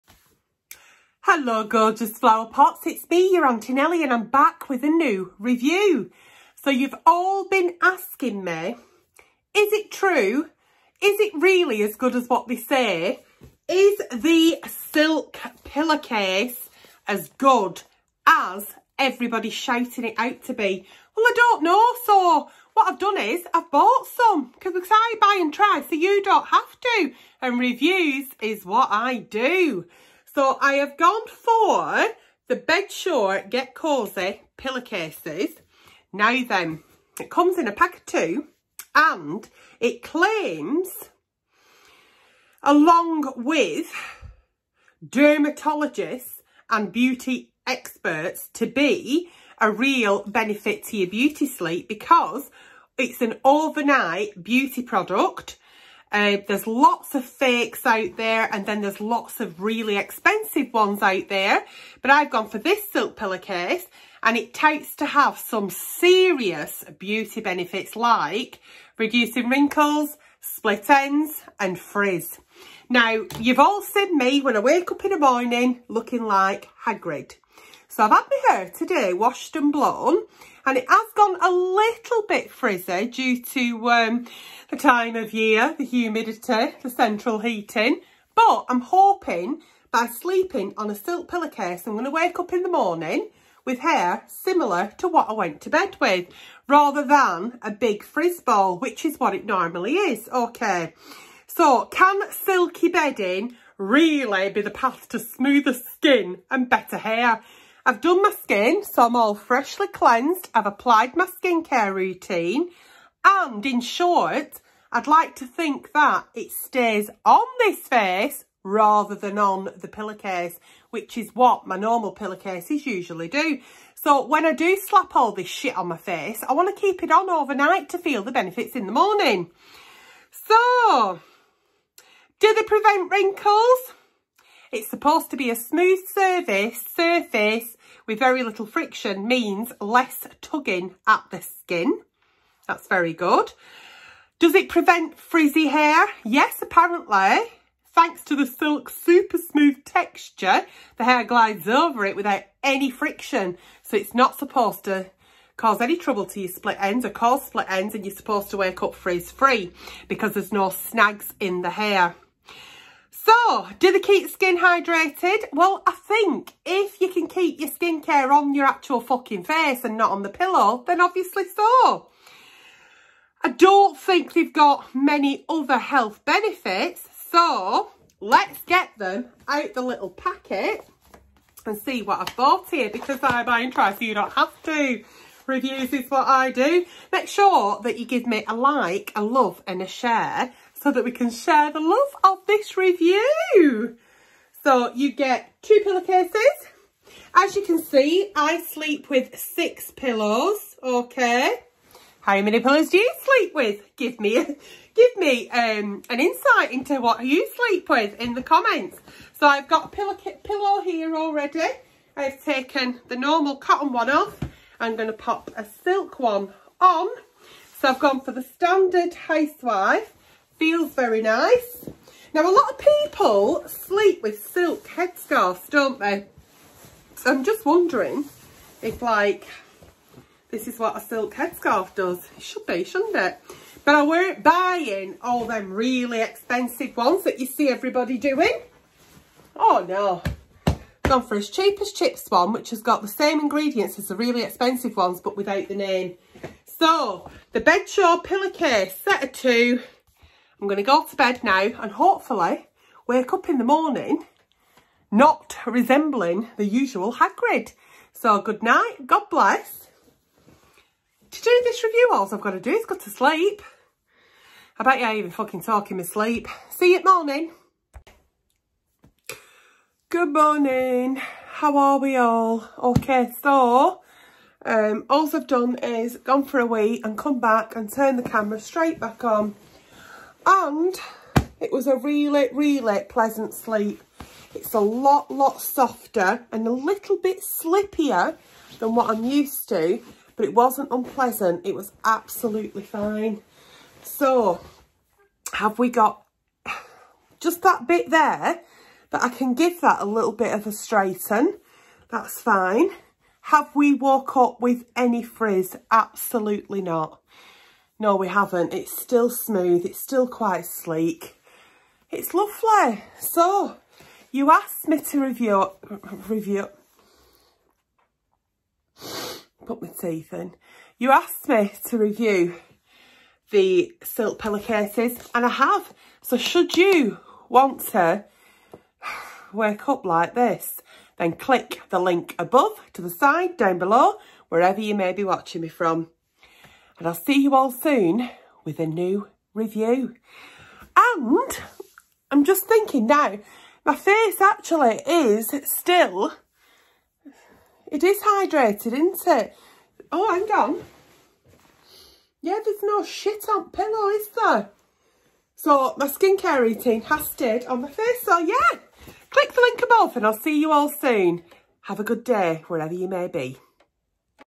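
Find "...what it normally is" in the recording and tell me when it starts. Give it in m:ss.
1:39.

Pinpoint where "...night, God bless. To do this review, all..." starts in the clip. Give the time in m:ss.
4:18.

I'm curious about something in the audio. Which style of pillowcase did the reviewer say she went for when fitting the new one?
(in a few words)
standard housewife.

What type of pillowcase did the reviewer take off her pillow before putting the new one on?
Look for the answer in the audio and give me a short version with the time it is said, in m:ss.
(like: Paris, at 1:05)
cotton, at 3:33.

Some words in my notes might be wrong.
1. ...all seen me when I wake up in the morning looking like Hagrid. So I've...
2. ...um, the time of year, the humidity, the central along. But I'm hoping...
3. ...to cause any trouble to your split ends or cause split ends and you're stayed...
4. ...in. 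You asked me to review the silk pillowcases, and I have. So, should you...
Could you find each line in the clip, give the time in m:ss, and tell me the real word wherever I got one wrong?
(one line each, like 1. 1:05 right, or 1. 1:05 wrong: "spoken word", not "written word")
1. 1:13 right
2. 1:23 wrong: "heating", not "along"
3. 2:34 wrong: "supposed", not "stayed"
4. 5:20 right.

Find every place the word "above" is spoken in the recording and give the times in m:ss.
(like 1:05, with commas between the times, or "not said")
5:32, 5:59.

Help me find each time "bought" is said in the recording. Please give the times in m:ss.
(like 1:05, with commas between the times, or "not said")
0:23, 3:02.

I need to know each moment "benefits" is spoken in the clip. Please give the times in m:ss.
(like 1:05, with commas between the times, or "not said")
0:50, 1:07, 2:08, 2:56.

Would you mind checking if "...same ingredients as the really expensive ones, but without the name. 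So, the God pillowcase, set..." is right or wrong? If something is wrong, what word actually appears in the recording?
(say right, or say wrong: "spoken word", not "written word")
wrong: "Bedsure", not "God".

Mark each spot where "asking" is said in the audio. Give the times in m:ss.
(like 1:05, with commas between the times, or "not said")
0:07.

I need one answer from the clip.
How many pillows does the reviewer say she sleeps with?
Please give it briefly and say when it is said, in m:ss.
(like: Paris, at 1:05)
6, at 3:19.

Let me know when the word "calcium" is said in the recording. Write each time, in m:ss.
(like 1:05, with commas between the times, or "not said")
not said.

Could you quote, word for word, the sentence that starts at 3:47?
So I'm just wondering if, like, this is what a silk headscarf does.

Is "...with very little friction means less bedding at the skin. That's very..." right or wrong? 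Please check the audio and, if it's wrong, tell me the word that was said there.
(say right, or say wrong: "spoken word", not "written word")
wrong: "tugging", not "bedding".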